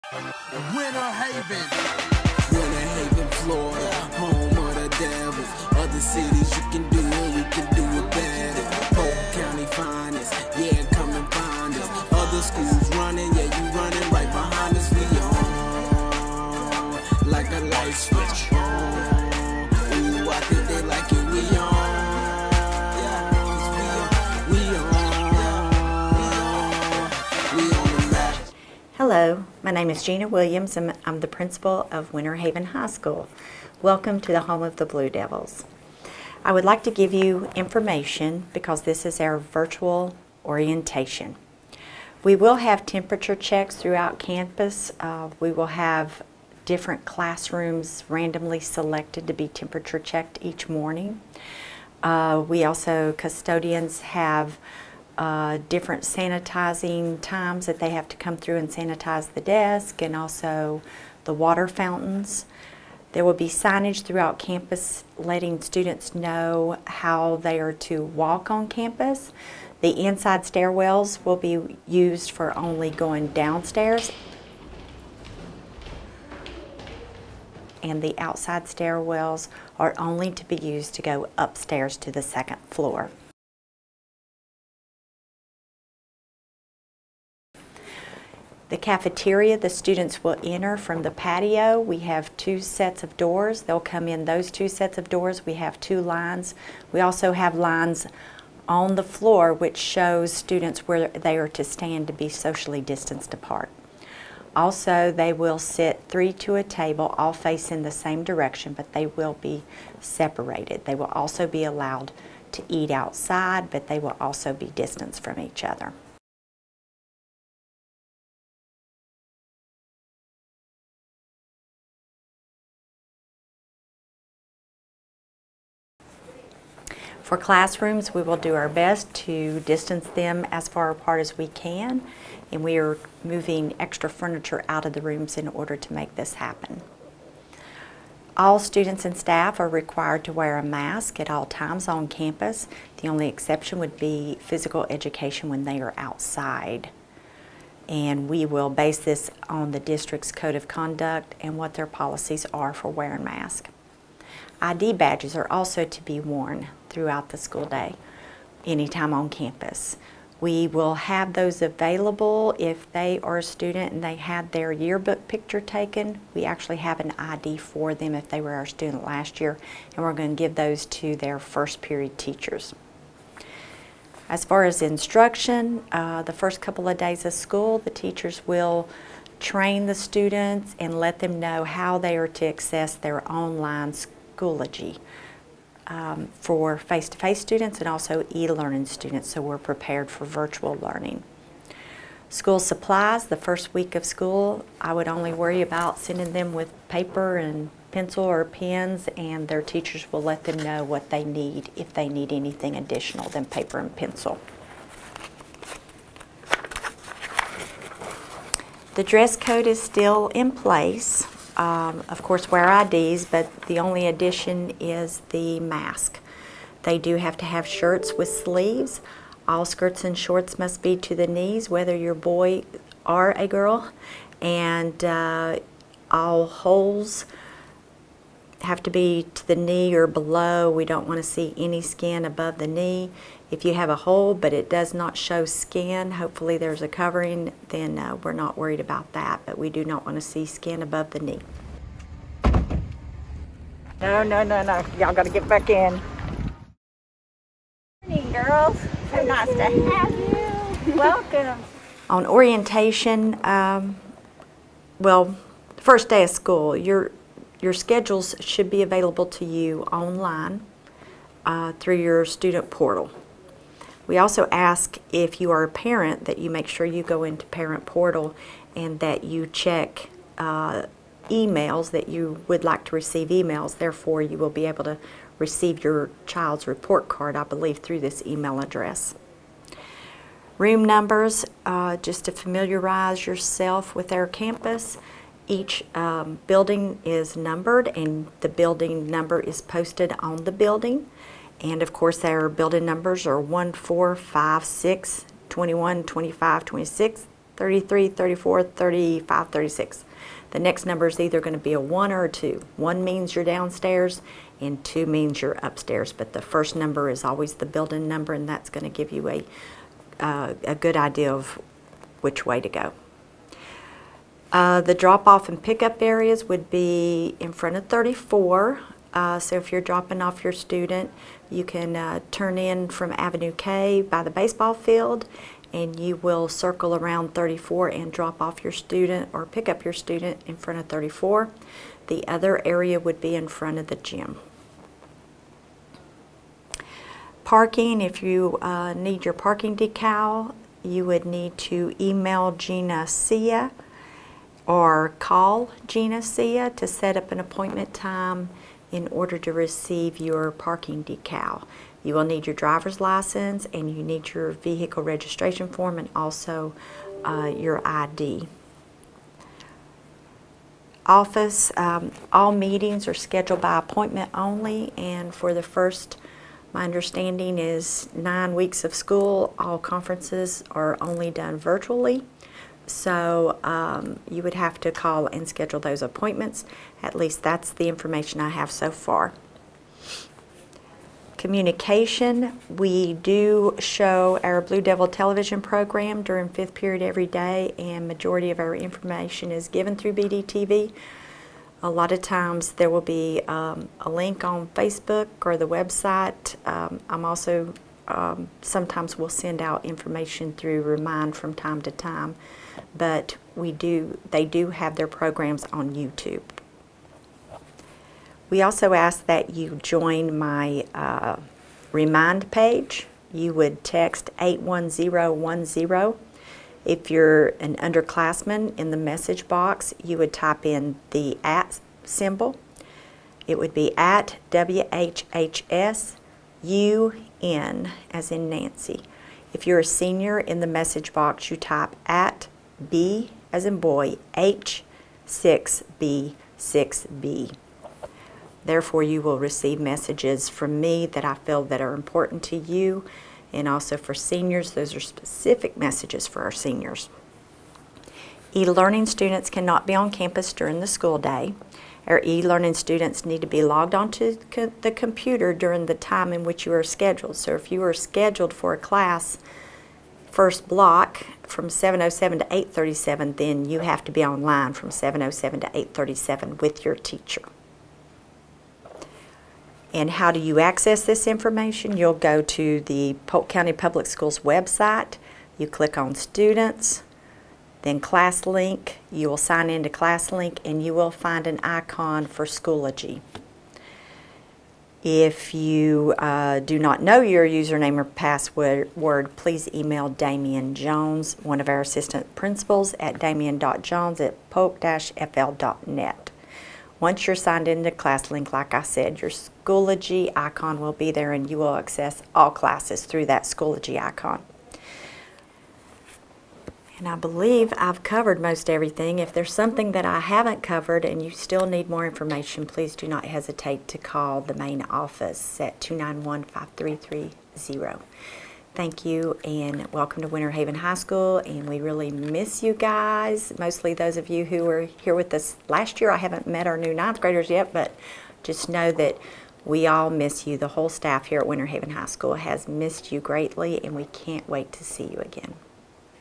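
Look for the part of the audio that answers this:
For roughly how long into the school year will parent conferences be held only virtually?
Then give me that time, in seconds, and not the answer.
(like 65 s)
368 s.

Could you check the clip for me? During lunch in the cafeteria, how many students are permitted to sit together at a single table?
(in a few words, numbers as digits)
3.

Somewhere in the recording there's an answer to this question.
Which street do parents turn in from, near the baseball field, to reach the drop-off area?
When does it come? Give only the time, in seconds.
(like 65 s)
323 s.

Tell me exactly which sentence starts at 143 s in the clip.
The only exception would be physical education when they are outside.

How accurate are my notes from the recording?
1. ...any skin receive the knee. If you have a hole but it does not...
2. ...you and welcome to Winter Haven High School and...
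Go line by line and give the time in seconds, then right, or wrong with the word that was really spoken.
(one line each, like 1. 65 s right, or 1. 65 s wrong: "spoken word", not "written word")
1. 231 s wrong: "above", not "receive"
2. 519 s right.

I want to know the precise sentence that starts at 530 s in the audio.
The whole staff here at Winter Haven High School has missed you greatly and we can't wait to see you again.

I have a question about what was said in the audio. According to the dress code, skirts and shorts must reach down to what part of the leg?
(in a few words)
the knees.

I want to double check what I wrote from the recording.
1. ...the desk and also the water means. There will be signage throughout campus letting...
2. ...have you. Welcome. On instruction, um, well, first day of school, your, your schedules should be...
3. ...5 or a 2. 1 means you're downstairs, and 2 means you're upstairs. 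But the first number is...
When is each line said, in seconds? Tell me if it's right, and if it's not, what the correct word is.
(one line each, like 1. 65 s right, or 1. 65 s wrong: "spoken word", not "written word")
1. 59 s wrong: "fountains", not "means"
2. 249 s wrong: "orientation", not "instruction"
3. 301 s wrong: "1", not "5".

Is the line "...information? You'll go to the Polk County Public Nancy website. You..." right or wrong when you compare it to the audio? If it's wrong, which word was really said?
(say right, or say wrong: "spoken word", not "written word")
wrong: "Schools", not "Nancy".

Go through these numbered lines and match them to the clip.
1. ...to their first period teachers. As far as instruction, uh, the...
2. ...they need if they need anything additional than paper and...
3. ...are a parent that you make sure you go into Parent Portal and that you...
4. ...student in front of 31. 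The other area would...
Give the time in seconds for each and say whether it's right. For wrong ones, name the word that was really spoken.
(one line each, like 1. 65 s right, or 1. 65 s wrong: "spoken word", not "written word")
1. 170 s right
2. 201 s right
3. 265 s right
4. 329 s wrong: "34", not "31".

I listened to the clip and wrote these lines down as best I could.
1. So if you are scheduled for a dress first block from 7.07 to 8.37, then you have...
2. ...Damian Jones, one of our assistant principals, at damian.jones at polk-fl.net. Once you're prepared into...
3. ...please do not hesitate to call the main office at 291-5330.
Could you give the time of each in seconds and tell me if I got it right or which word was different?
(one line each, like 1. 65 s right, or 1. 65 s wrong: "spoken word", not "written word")
1. 457 s wrong: "class", not "dress"
2. 490 s wrong: "signed", not "prepared"
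3. 512 s right.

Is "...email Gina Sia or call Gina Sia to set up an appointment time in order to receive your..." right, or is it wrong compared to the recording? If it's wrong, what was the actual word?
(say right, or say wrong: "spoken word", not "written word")
right.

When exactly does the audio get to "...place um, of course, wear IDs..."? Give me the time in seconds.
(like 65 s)
210 s.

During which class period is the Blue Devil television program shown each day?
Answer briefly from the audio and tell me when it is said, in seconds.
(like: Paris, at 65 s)
fifth period, at 386 s.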